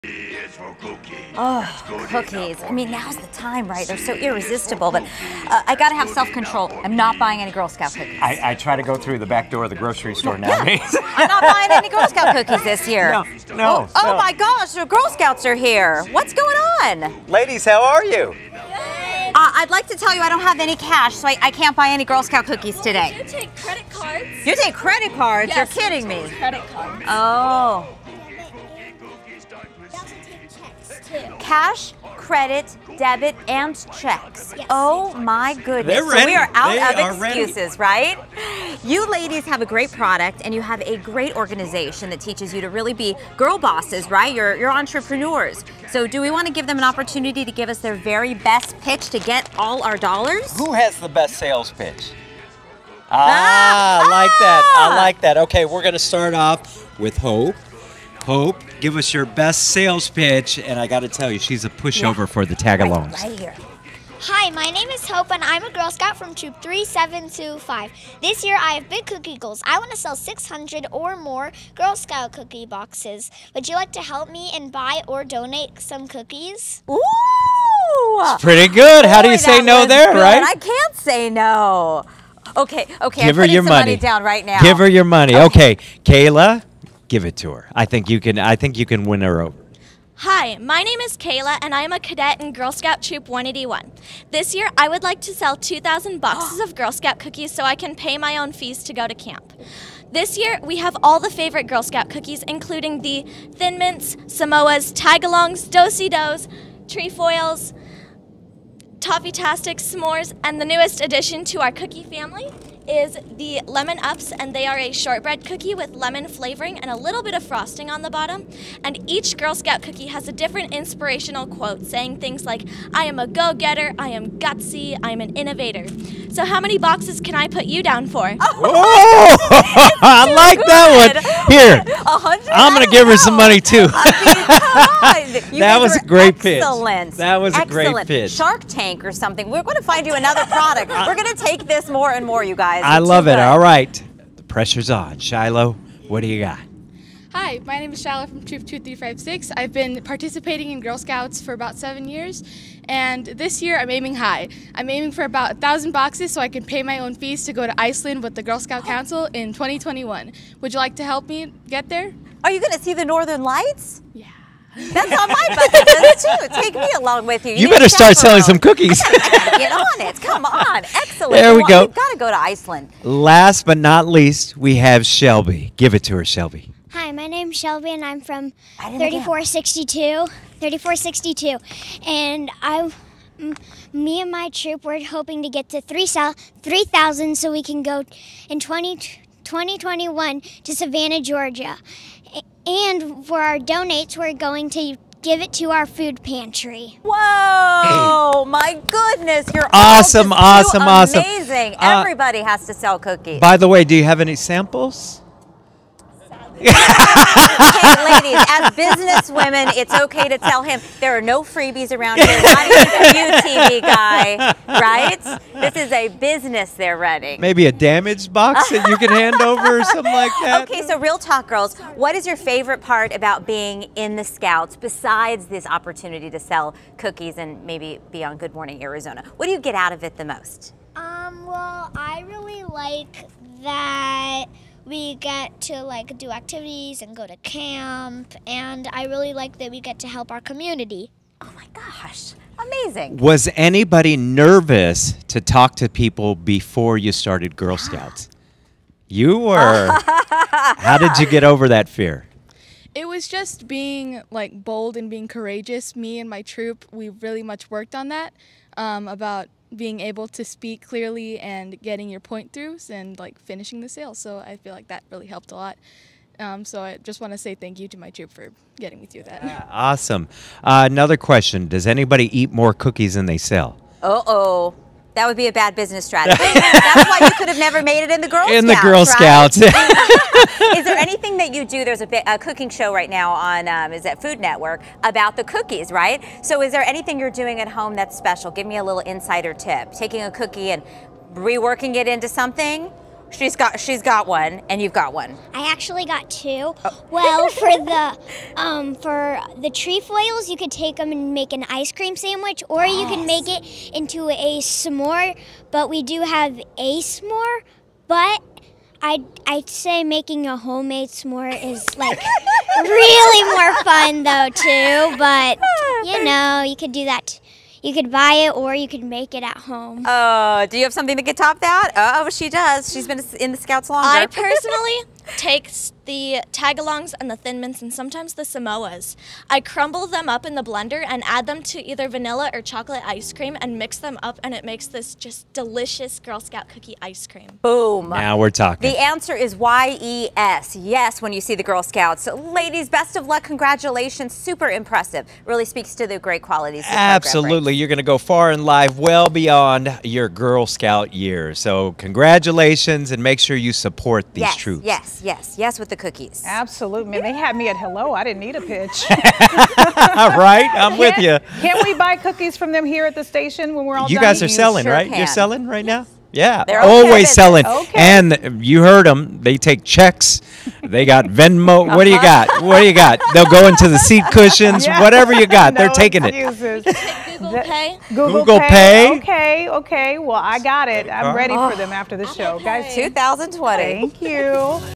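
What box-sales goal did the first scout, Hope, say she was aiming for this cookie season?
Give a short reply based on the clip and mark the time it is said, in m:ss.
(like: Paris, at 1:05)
600, at 1:10.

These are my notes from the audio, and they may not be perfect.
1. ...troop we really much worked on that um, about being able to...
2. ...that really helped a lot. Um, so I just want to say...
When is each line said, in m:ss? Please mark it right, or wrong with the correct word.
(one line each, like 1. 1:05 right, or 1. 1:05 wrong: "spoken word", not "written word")
1. 4:16 right
2. 4:24 right.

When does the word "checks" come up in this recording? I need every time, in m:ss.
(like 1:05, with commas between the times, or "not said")
0:33, 6:09.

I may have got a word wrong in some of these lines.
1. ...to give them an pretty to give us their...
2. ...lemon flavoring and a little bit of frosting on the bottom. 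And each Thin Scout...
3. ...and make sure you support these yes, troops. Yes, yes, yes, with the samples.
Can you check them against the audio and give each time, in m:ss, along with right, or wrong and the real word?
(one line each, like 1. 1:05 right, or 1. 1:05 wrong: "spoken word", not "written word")
1. 0:46 wrong: "opportunity", not "pretty"
2. 1:55 wrong: "Girl", not "Thin"
3. 5:53 wrong: "cookies", not "samples".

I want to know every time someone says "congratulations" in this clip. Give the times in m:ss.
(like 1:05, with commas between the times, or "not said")
5:43, 5:51.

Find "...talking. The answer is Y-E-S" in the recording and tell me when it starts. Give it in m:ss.
5:38.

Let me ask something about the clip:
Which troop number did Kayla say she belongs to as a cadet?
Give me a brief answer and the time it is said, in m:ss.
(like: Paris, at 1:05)
181, at 1:33.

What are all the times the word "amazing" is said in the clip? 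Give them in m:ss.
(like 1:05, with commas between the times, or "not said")
3:21, 4:02.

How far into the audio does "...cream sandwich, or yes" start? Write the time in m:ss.
5:01.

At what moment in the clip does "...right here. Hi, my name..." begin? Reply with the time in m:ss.
1:03.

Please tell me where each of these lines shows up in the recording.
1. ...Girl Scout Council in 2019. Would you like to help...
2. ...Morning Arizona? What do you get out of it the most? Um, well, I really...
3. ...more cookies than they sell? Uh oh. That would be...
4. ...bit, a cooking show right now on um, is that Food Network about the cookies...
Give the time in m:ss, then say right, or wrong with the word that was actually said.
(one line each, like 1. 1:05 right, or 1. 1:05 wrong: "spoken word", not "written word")
1. 2:38 wrong: "2021", not "2019"
2. 3:48 right
3. 4:32 right
4. 4:42 right.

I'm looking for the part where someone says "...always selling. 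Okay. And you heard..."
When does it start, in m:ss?
6:06.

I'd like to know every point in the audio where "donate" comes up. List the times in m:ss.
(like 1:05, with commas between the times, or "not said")
1:15, 3:13.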